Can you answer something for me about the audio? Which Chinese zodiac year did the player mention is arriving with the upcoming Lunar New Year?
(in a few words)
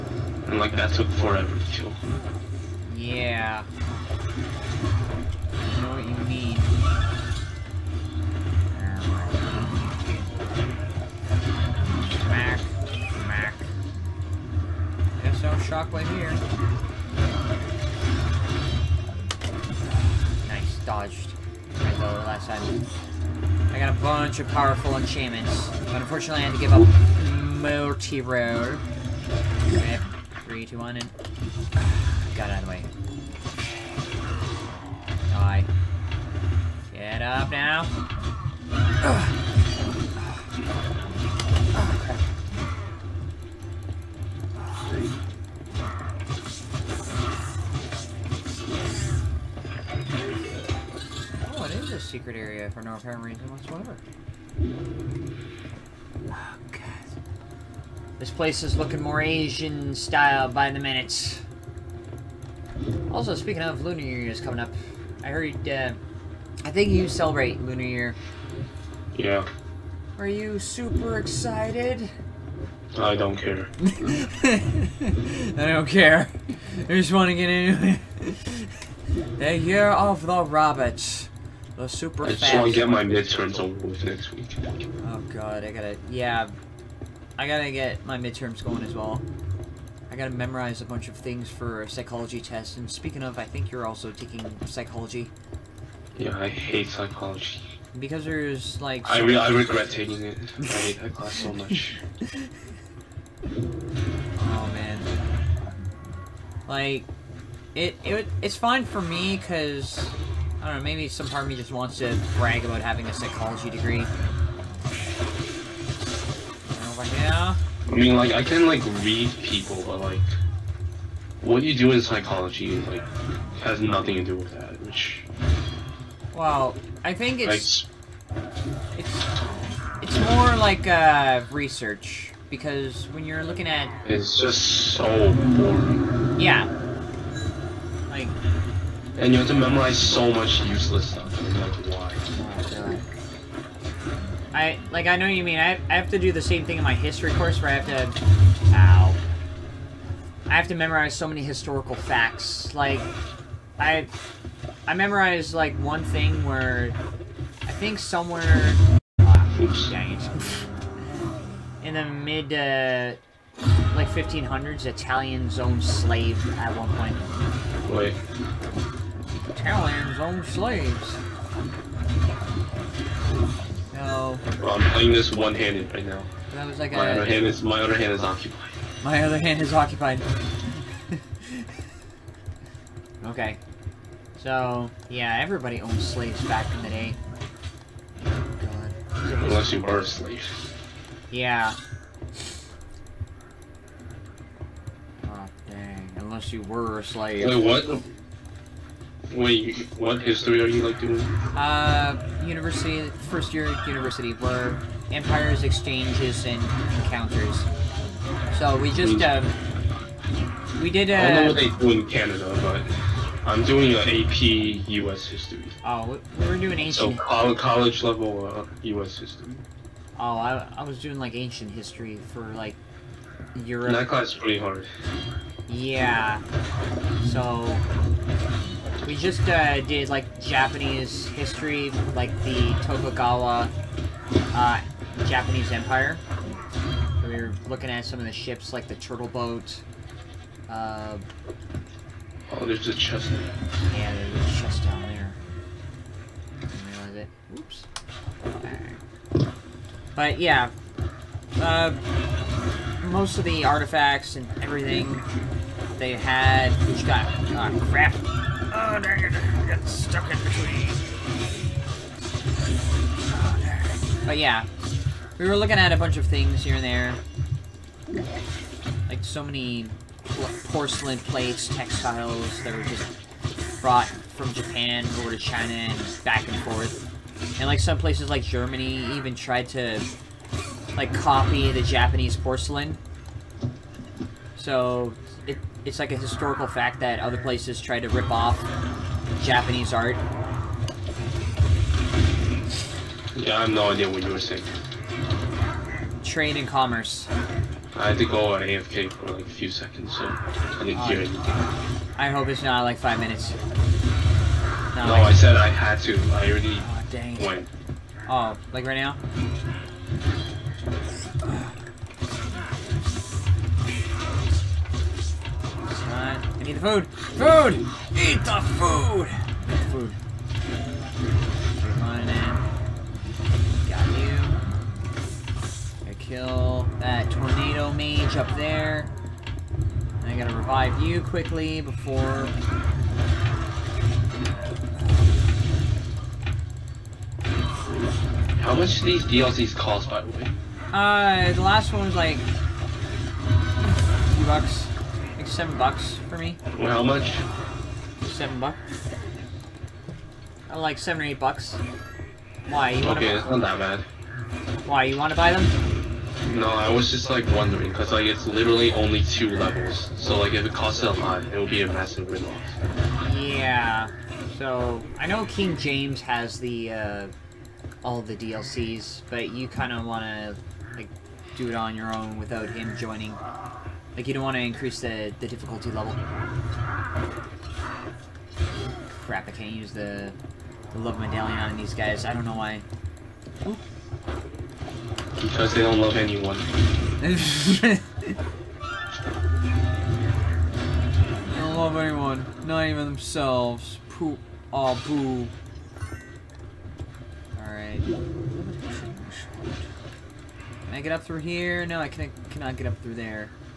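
Year of the Rabbit.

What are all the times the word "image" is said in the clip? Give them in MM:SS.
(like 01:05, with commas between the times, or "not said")
not said.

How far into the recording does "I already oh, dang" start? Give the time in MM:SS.
05:06.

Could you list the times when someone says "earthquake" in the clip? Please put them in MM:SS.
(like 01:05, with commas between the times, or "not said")
not said.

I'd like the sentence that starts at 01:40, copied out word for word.
I hate that class so much.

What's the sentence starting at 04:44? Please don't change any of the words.
So it, it's like a historical fact that other places try to rip off Japanese art.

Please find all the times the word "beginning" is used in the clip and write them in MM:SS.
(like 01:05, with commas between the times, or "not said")
not said.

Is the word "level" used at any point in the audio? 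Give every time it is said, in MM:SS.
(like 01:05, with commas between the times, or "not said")
03:38, 05:59, 06:15.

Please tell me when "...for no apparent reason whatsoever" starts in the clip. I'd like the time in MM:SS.
00:52.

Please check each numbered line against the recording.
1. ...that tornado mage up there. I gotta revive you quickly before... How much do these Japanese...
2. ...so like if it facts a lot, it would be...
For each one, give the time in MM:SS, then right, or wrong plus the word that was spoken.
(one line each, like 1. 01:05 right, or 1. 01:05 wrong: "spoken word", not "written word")
1. 05:27 wrong: "DLCs", not "Japanese"
2. 06:00 wrong: "costs", not "facts".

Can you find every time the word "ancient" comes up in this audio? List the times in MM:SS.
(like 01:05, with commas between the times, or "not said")
03:36, 03:41.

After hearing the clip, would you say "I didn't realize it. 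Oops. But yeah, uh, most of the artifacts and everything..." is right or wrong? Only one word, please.
right.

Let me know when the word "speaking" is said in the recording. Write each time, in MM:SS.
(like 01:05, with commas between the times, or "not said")
01:03, 01:32.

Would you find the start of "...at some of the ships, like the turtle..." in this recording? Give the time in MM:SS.
03:57.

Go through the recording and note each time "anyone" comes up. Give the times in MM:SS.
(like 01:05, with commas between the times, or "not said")
06:26, 06:31.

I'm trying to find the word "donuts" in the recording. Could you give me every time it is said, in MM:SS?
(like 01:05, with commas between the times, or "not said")
not said.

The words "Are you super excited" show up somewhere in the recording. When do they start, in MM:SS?
01:10.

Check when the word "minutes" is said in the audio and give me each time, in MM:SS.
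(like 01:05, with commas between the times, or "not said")
01:00, 05:03.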